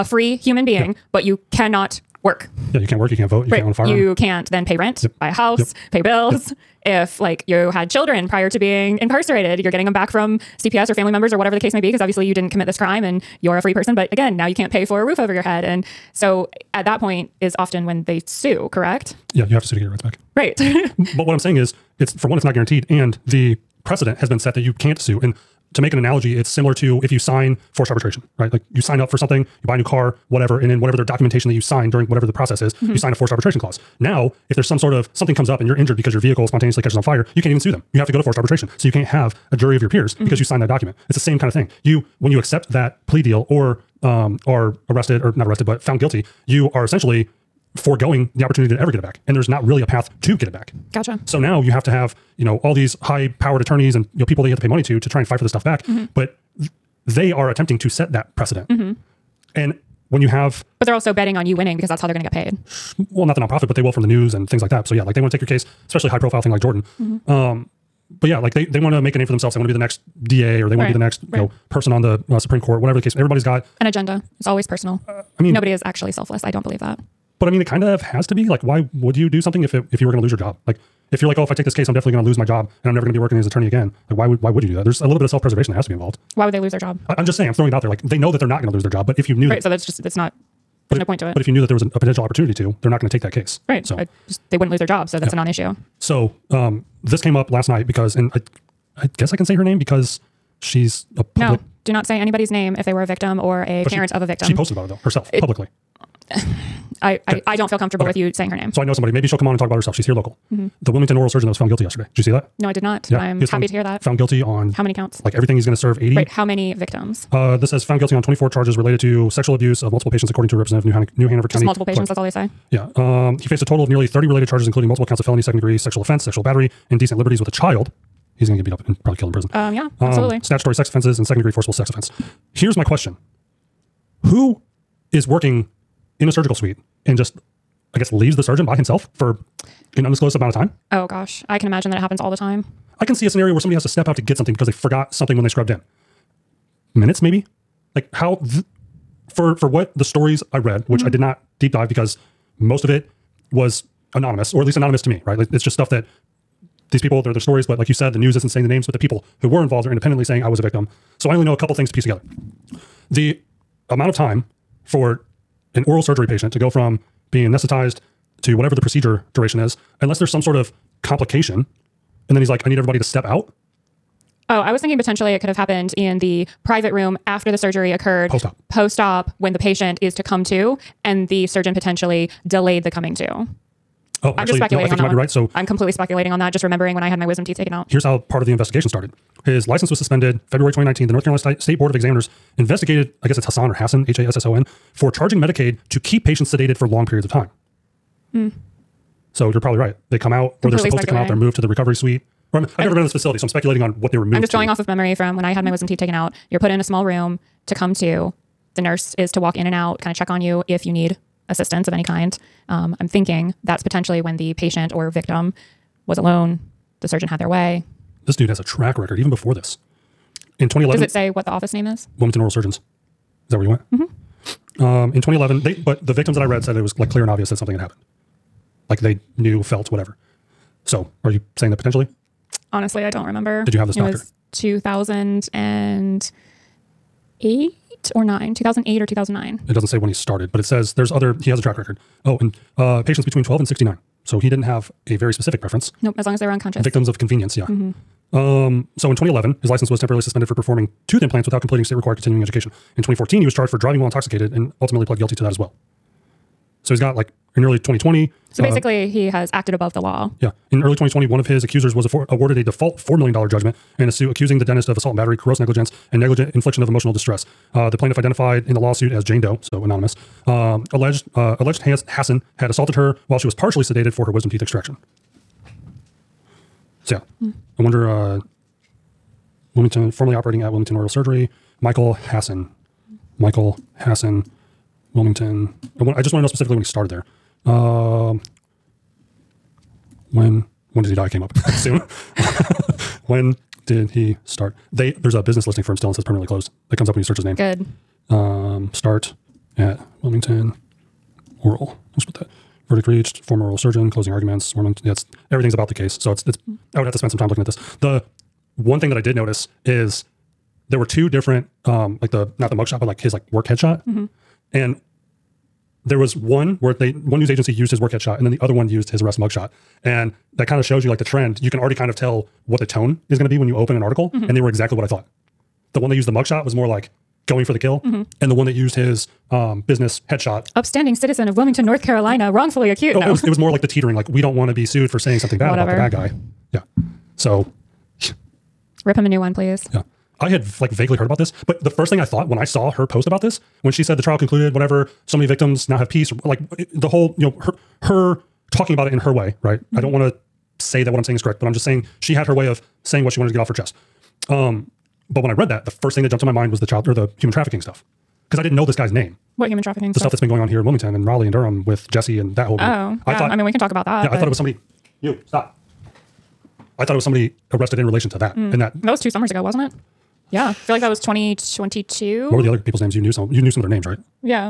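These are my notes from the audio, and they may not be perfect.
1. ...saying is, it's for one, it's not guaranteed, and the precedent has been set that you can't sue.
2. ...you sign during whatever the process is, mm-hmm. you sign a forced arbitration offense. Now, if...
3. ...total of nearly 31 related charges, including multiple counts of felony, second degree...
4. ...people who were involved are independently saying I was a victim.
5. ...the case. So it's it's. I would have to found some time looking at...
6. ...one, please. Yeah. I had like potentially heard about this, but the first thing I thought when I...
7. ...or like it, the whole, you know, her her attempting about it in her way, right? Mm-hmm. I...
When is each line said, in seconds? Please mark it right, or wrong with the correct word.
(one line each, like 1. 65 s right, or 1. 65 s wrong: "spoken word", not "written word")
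1. 21 s right
2. 31 s wrong: "clause", not "offense"
3. 123 s wrong: "30", not "31"
4. 158 s right
5. 305 s wrong: "spend", not "found"
6. 339 s wrong: "vaguely", not "potentially"
7. 346 s wrong: "talking", not "attempting".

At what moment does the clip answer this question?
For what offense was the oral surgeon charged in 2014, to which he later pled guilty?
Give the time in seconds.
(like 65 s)
253 s.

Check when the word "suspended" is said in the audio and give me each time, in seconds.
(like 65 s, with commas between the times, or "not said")
189 s, 250 s.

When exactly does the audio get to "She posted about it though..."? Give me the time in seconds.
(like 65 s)
104 s.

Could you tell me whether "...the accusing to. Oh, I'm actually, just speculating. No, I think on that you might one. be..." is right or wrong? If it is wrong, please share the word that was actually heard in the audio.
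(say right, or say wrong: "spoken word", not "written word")
wrong: "coming", not "accusing".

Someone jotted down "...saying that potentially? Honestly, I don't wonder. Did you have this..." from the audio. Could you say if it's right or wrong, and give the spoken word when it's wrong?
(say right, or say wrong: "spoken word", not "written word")
wrong: "remember", not "wonder".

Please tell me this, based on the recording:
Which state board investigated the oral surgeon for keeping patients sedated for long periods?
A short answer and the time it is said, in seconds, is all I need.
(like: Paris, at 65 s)
North Carolina State Board of Examiners, at 191 s.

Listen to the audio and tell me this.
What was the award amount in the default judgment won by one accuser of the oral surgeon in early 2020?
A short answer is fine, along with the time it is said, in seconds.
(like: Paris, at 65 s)
$4 million, at 262 s.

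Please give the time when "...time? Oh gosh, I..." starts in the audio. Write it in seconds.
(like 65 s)
140 s.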